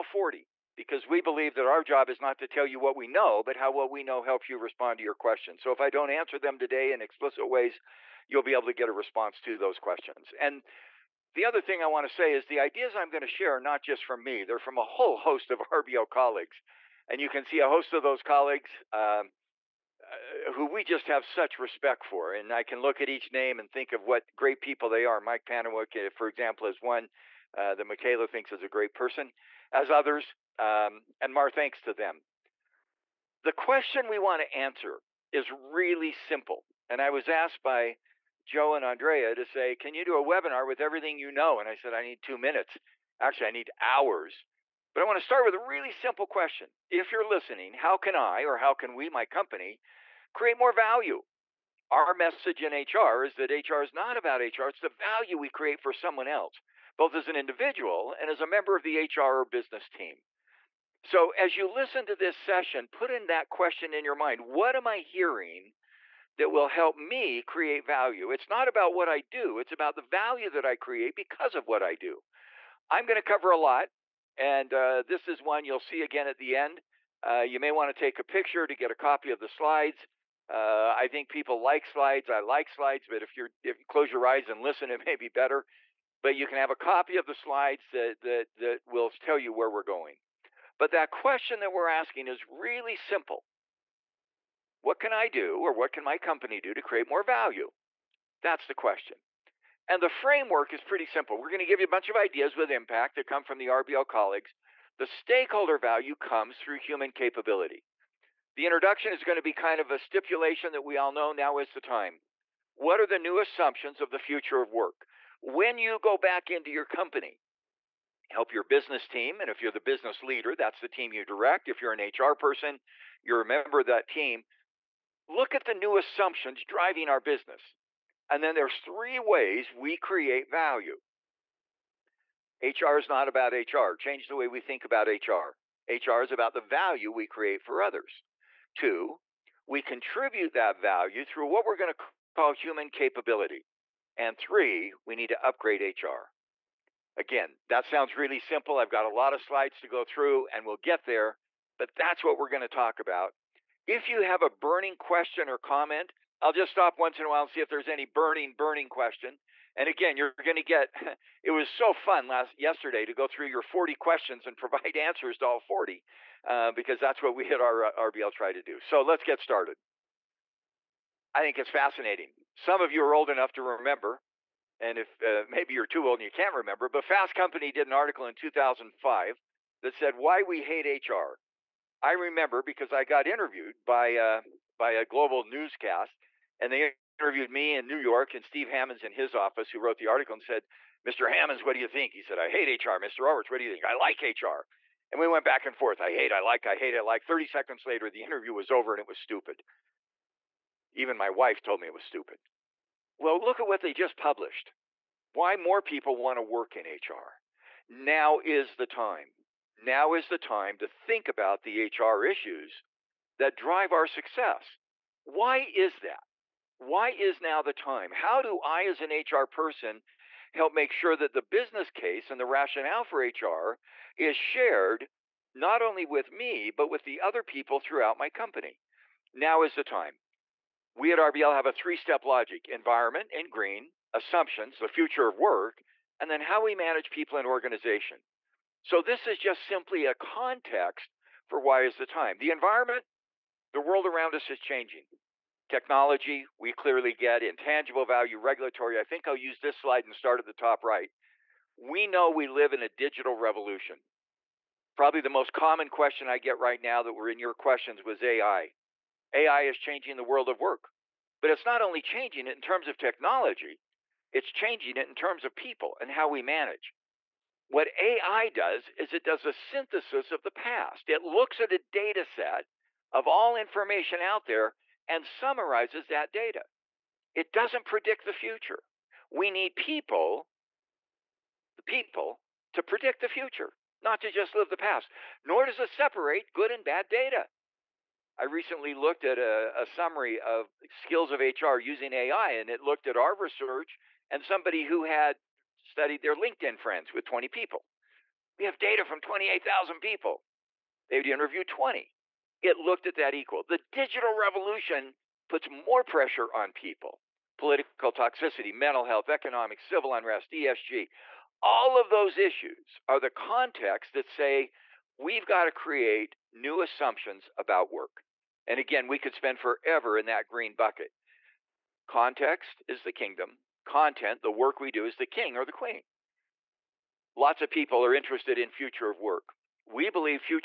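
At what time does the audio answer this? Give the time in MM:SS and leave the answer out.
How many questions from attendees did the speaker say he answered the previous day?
02:45.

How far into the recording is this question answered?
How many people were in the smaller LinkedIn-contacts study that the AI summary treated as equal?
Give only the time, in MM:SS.
04:57.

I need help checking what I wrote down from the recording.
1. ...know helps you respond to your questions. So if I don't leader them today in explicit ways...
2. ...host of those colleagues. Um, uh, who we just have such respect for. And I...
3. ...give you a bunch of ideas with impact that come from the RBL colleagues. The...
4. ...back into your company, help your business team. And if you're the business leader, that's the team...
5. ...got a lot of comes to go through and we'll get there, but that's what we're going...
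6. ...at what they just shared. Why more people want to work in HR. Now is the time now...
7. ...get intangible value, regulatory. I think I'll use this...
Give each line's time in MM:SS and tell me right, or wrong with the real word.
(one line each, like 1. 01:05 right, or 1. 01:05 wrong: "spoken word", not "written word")
1. 00:04 wrong: "answer", not "leader"
2. 00:17 right
3. 01:41 right
4. 01:56 right
5. 02:28 wrong: "slides", not "comes"
6. 03:23 wrong: "published", not "shared"
7. 04:07 right.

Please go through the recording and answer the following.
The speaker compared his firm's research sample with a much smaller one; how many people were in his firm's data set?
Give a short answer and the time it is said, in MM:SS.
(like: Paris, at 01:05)
28,000, at 04:59.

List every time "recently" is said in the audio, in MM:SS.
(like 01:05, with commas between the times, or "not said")
04:48.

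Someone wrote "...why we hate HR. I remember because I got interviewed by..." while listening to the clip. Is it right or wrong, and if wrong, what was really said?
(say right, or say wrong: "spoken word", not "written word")
right.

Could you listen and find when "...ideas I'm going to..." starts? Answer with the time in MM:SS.
00:12.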